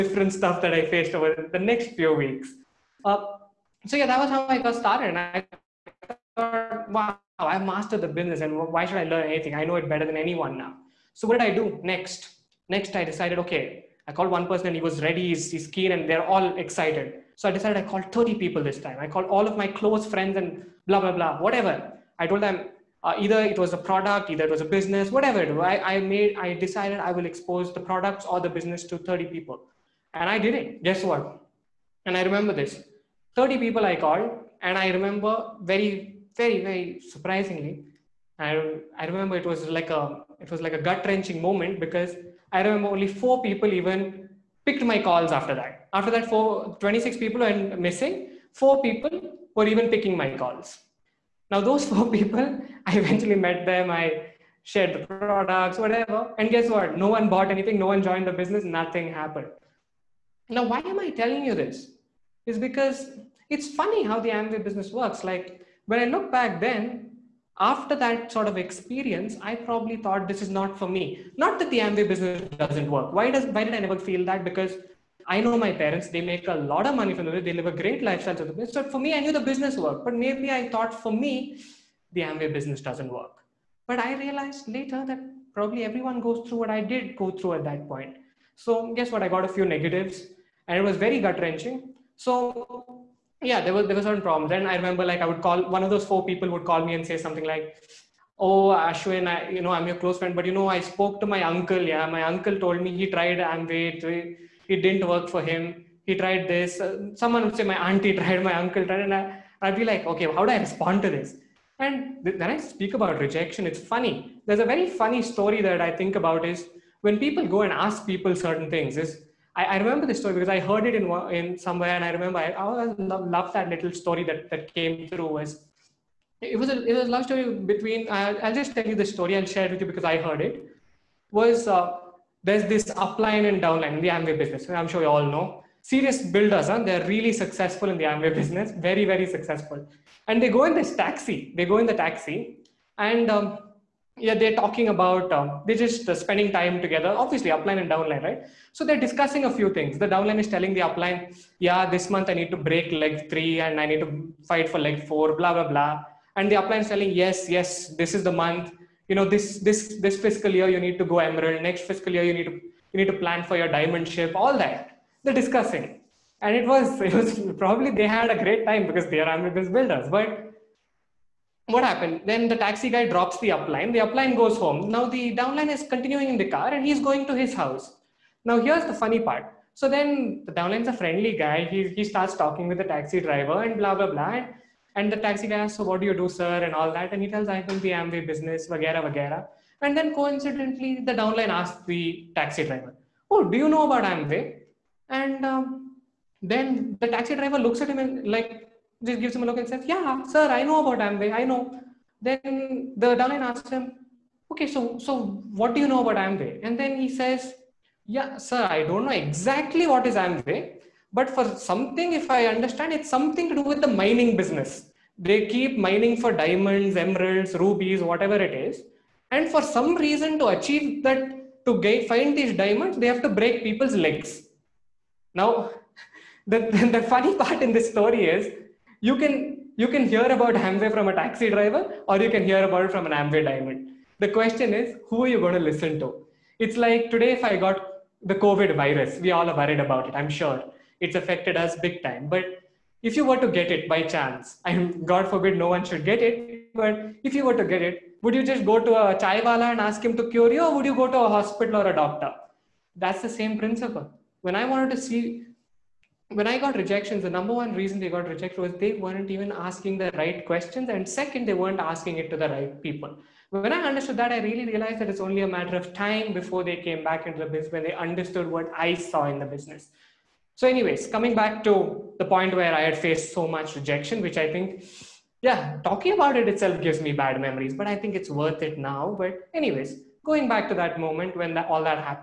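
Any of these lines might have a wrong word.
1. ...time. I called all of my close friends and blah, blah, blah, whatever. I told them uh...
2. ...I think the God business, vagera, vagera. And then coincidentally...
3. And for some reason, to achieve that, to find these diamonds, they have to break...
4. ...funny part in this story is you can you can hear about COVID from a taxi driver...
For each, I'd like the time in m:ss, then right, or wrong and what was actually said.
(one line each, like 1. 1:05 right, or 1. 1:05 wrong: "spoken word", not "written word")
1. 0:18 right
2. 3:07 wrong: "Amway", not "God"
3. 3:39 right
4. 3:47 wrong: "Amway", not "COVID".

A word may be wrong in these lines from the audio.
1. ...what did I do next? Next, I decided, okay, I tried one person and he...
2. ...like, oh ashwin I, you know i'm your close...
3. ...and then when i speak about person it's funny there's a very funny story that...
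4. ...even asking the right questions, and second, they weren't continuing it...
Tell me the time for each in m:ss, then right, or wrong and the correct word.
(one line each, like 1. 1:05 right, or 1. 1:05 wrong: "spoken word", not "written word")
1. 0:11 wrong: "called", not "tried"
2. 1:37 right
3. 1:51 wrong: "rejection", not "person"
4. 4:19 wrong: "asking", not "continuing".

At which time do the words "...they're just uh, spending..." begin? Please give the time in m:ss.
2:25.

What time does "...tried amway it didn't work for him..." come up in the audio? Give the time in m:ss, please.
1:43.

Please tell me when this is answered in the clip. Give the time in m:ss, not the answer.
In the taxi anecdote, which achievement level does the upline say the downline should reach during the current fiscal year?
2:41.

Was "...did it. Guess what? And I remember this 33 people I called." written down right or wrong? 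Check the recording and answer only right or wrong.
wrong.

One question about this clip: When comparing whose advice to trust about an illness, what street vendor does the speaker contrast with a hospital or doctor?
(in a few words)
Chaiwala.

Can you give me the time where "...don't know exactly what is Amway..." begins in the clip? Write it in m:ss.
3:28.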